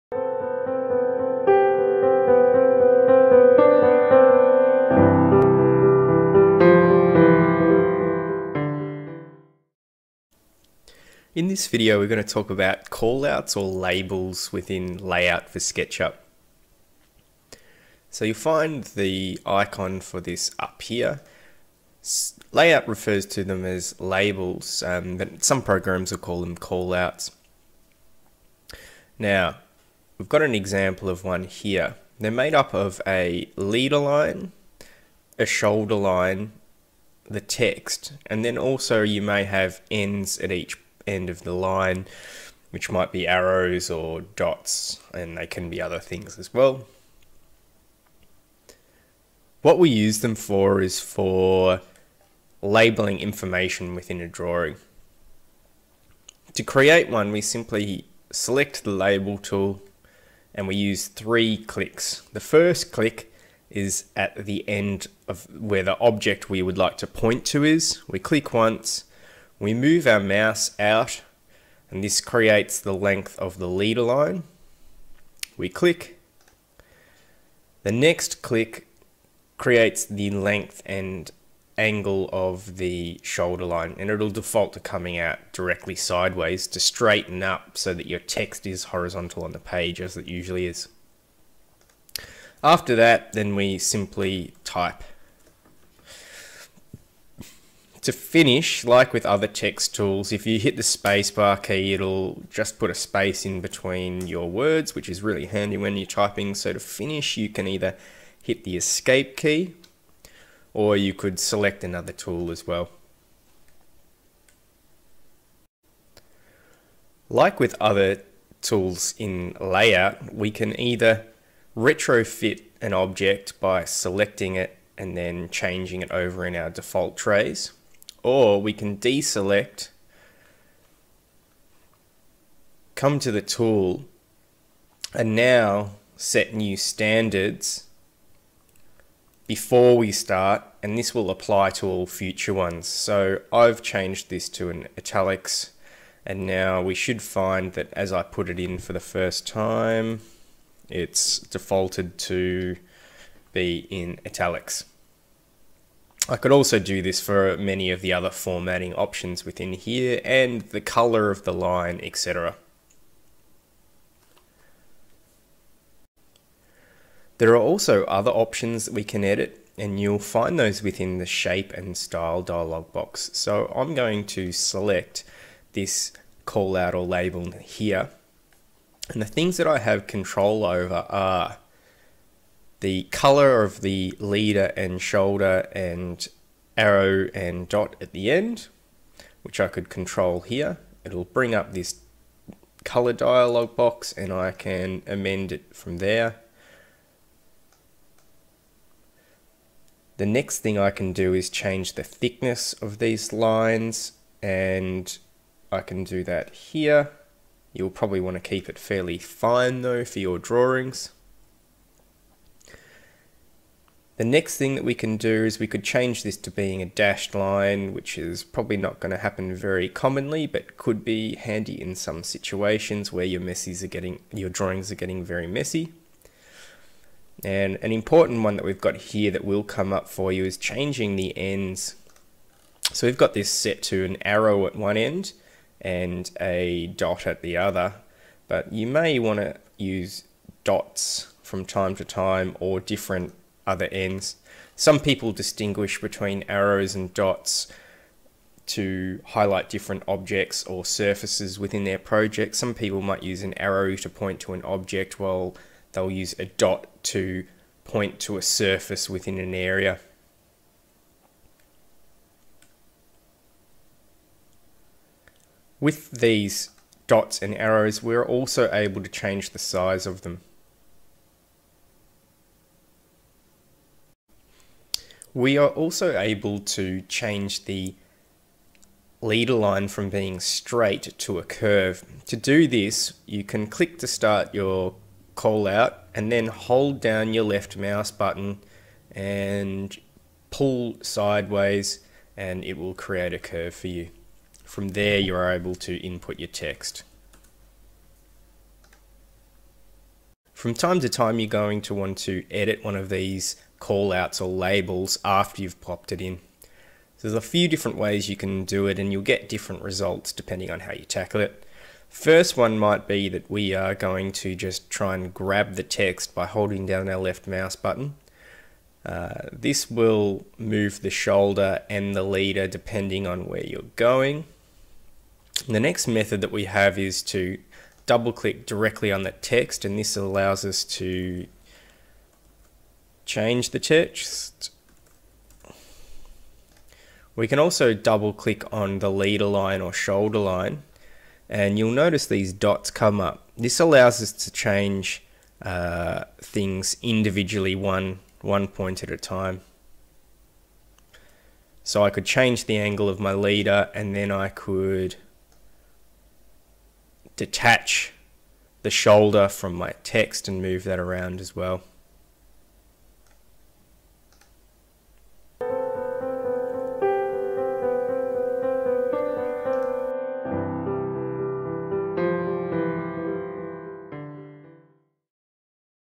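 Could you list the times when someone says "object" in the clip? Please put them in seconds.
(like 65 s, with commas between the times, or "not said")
65 s, 122 s, 250 s, 254 s.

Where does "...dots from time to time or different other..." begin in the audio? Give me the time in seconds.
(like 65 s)
240 s.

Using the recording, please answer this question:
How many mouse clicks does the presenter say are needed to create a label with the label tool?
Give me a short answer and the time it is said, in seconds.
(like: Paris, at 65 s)
3, at 61 s.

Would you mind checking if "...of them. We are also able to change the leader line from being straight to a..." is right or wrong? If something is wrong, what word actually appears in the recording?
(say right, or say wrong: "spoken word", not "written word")
right.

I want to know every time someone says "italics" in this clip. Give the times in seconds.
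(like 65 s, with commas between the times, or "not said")
144 s, 154 s.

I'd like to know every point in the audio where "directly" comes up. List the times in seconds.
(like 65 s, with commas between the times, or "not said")
85 s, 328 s.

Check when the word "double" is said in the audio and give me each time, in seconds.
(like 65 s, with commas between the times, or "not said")
328 s, 337 s.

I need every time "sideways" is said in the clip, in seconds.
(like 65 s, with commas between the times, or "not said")
85 s, 291 s.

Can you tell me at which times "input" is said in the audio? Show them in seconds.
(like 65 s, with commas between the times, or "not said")
295 s.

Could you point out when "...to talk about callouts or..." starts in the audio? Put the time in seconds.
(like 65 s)
12 s.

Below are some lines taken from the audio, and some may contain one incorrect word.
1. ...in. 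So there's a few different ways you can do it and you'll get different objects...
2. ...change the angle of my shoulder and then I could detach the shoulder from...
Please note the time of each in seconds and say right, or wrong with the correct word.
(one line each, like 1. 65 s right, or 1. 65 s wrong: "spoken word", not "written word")
1. 306 s wrong: "results", not "objects"
2. 352 s wrong: "leader", not "shoulder".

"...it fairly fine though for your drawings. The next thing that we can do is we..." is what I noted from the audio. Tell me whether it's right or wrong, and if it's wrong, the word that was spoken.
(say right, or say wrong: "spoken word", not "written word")
right.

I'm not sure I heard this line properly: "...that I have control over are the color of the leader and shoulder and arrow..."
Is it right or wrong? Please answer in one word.
right.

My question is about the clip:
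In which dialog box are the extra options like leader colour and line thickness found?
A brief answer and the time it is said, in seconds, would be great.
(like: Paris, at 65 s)
shape and style, at 171 s.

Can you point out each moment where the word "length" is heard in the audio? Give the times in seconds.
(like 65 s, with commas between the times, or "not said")
72 s, 80 s.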